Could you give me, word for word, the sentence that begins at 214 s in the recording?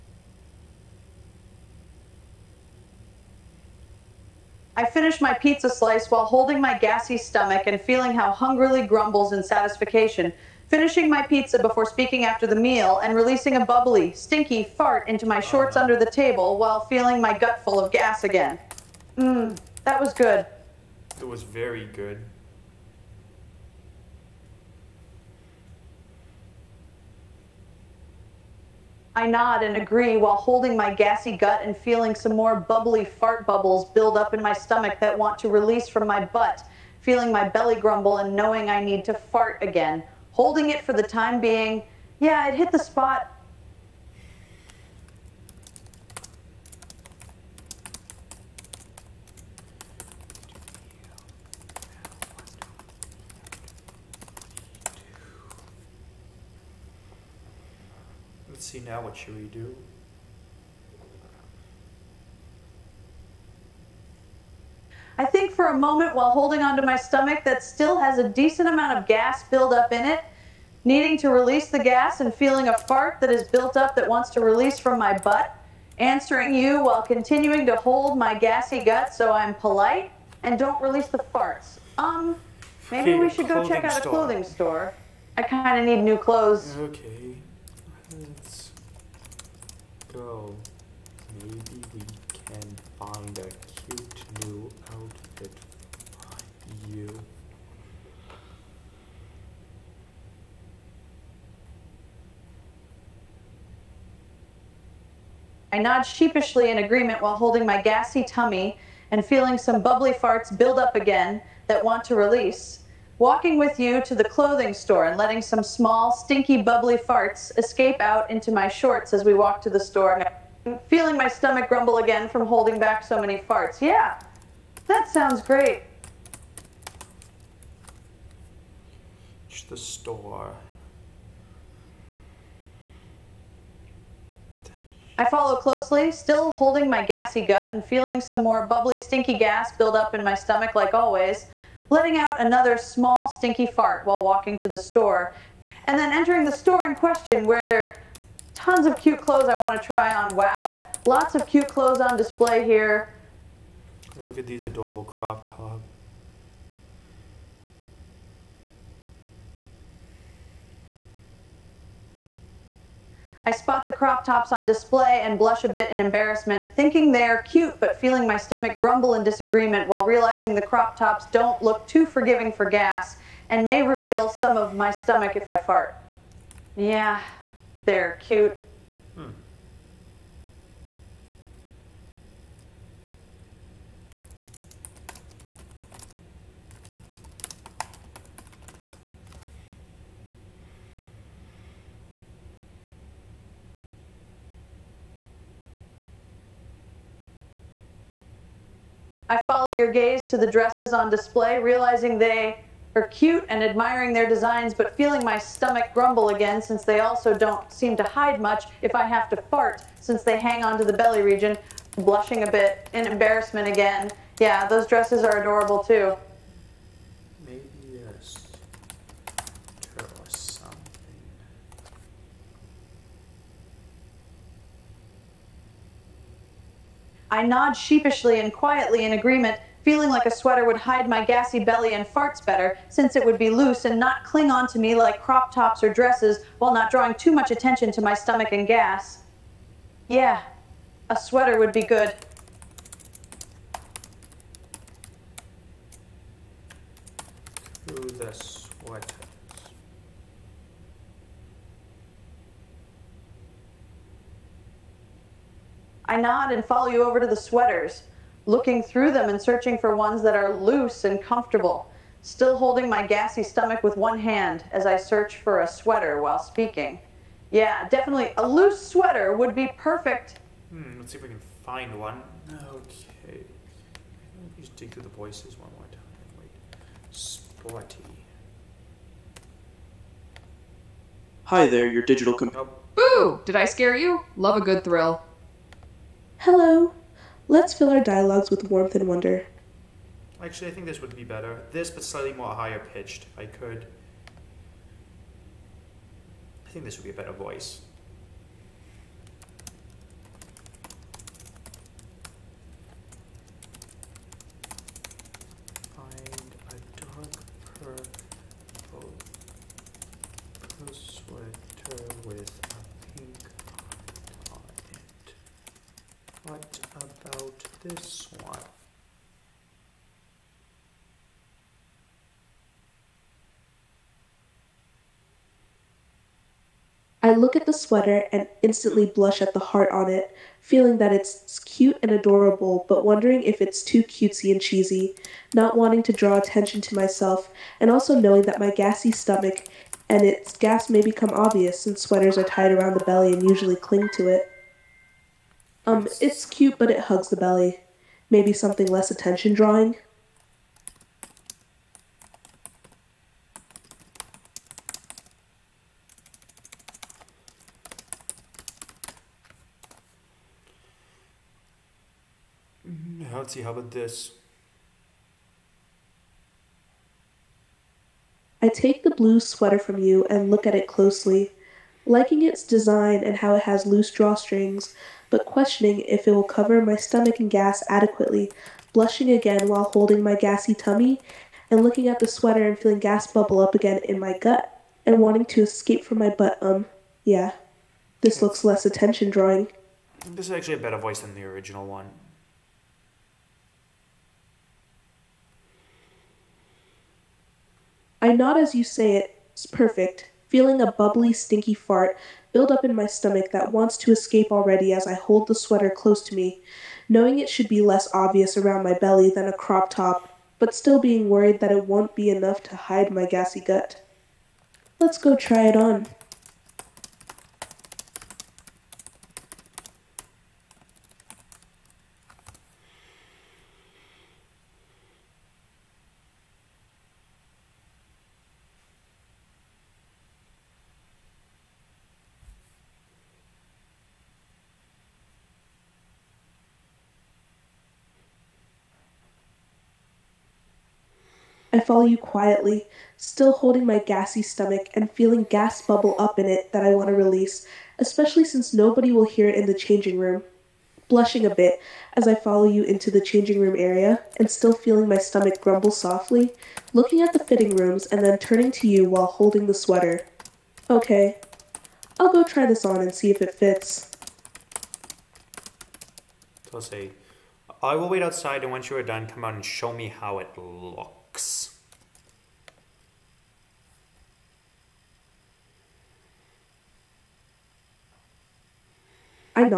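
Yeah, those dresses are adorable too.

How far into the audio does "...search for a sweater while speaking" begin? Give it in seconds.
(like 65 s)
264 s.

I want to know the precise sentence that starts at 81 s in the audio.
Um, maybe we should go check out a clothing store.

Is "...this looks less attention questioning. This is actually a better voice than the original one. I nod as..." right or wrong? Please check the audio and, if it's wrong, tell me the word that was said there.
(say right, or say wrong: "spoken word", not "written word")
wrong: "drawing", not "questioning".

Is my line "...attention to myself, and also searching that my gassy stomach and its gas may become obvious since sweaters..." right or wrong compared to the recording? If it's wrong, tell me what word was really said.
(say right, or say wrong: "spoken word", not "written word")
wrong: "knowing", not "searching".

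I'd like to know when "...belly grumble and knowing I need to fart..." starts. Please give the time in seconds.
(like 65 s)
37 s.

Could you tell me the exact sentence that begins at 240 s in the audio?
Yeah, a sweater would be good.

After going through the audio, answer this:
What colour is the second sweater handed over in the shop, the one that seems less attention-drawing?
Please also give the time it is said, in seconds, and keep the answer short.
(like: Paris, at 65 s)
blue, at 369 s.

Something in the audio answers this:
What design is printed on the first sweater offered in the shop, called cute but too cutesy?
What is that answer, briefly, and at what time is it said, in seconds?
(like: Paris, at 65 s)
heart, at 329 s.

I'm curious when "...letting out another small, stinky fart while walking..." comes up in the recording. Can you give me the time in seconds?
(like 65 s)
141 s.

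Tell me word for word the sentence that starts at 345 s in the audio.
Um, it's cute, but it hugs the belly.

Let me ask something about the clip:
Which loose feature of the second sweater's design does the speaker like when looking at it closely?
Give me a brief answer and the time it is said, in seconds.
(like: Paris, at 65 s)
drawstrings, at 373 s.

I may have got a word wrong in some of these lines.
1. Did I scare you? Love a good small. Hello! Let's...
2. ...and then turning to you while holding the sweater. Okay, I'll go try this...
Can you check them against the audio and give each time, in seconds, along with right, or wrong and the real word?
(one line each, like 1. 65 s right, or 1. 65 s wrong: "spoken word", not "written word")
1. 283 s wrong: "thrill", not "small"
2. 458 s right.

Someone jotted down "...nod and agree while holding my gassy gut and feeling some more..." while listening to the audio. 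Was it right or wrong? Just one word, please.
right.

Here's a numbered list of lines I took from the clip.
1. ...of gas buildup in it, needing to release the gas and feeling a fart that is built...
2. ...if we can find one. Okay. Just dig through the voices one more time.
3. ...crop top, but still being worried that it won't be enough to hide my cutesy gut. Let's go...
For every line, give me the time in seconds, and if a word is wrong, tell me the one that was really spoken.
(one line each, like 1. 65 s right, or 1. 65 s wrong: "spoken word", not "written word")
1. 68 s right
2. 271 s right
3. 409 s wrong: "gassy", not "cutesy".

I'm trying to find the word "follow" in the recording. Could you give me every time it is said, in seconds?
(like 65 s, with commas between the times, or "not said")
135 s, 199 s, 256 s, 441 s, 452 s.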